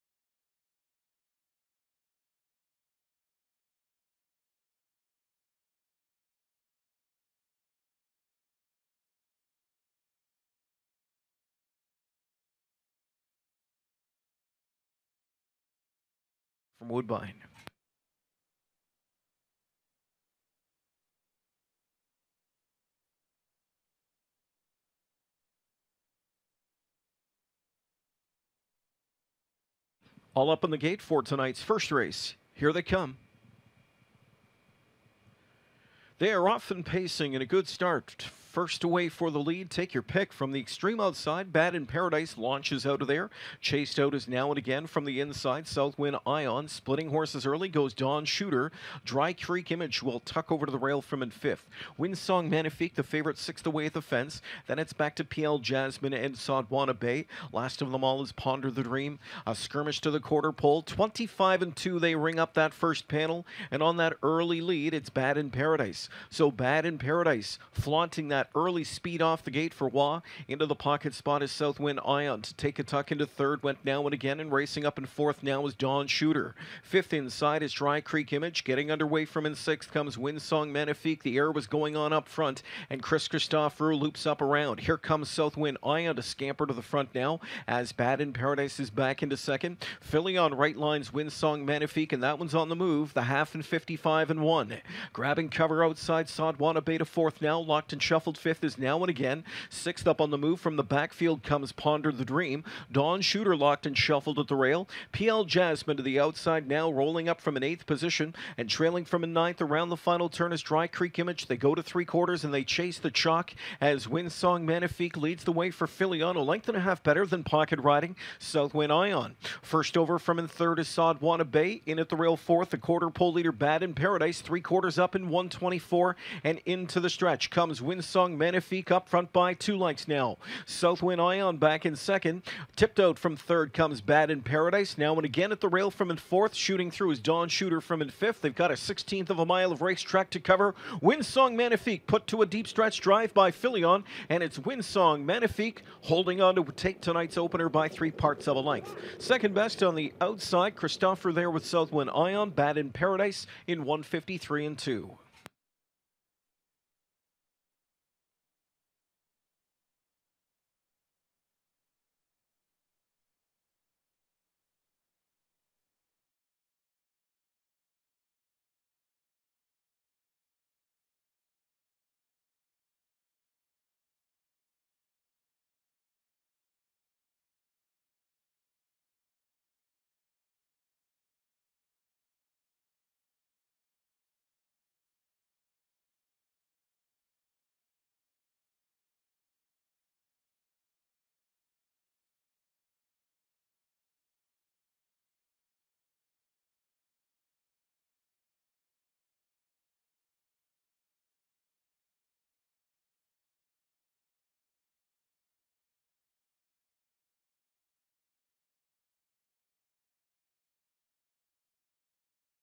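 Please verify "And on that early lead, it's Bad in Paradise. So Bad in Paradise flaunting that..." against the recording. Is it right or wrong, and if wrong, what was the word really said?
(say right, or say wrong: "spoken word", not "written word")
right.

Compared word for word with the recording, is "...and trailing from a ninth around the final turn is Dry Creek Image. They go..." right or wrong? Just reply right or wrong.
right.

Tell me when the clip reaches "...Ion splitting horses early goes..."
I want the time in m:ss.
0:46.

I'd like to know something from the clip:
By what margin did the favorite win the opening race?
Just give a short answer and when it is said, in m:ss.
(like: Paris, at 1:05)
Three parts of a length, at 2:27.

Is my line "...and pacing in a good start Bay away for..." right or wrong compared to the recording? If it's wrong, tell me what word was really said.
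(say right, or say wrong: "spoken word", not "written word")
wrong: "First", not "Bay".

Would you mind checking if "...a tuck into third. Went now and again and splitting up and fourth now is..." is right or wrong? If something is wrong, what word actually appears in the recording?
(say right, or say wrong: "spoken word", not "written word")
wrong: "racing", not "splitting".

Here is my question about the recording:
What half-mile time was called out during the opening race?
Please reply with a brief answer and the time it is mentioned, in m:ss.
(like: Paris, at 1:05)
55 and 1, at 1:33.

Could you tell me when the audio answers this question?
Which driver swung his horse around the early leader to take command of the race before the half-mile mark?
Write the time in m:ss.
1:23.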